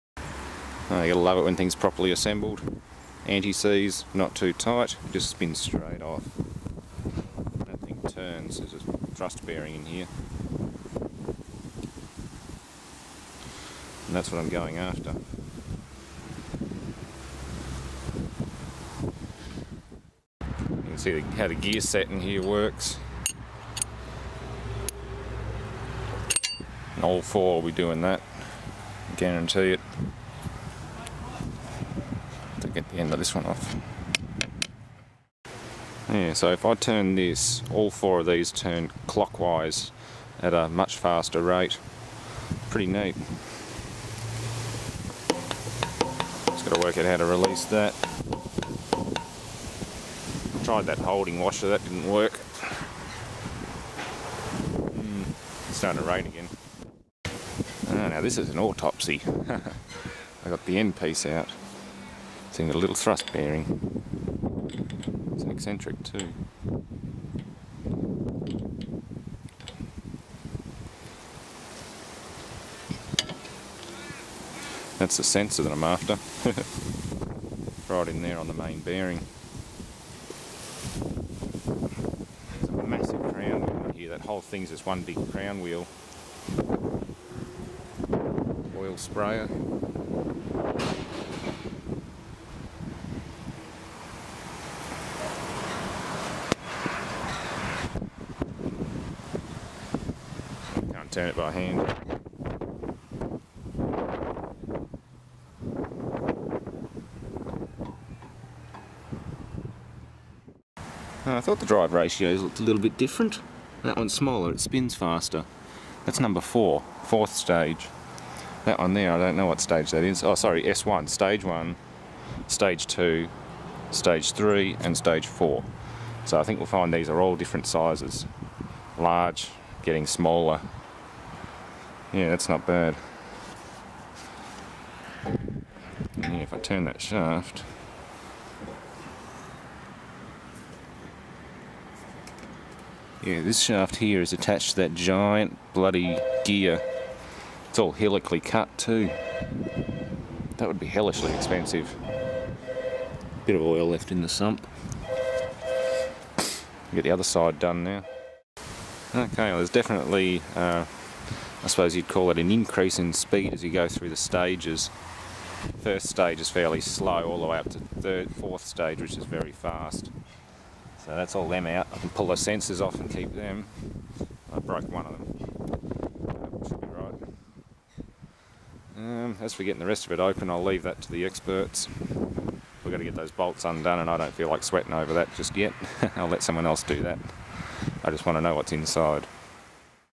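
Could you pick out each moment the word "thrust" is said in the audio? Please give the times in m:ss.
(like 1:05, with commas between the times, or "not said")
0:09, 1:02.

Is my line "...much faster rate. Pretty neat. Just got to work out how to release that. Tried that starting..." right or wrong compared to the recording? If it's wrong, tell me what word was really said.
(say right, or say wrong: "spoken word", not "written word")
wrong: "holding", not "starting".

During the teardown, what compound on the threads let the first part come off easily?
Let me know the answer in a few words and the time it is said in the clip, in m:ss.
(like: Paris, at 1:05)
Anti-seize, at 0:03.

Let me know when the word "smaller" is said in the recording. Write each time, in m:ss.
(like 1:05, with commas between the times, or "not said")
1:54, 2:10.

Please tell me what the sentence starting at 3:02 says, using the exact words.
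We've got to get those bolts undone, and I don't feel like sweating over that just yet.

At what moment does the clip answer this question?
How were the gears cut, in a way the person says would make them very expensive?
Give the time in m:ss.
2:27.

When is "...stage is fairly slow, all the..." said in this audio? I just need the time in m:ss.
2:46.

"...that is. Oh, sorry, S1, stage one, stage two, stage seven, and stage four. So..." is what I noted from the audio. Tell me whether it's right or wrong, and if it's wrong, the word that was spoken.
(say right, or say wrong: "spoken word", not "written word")
wrong: "three", not "seven".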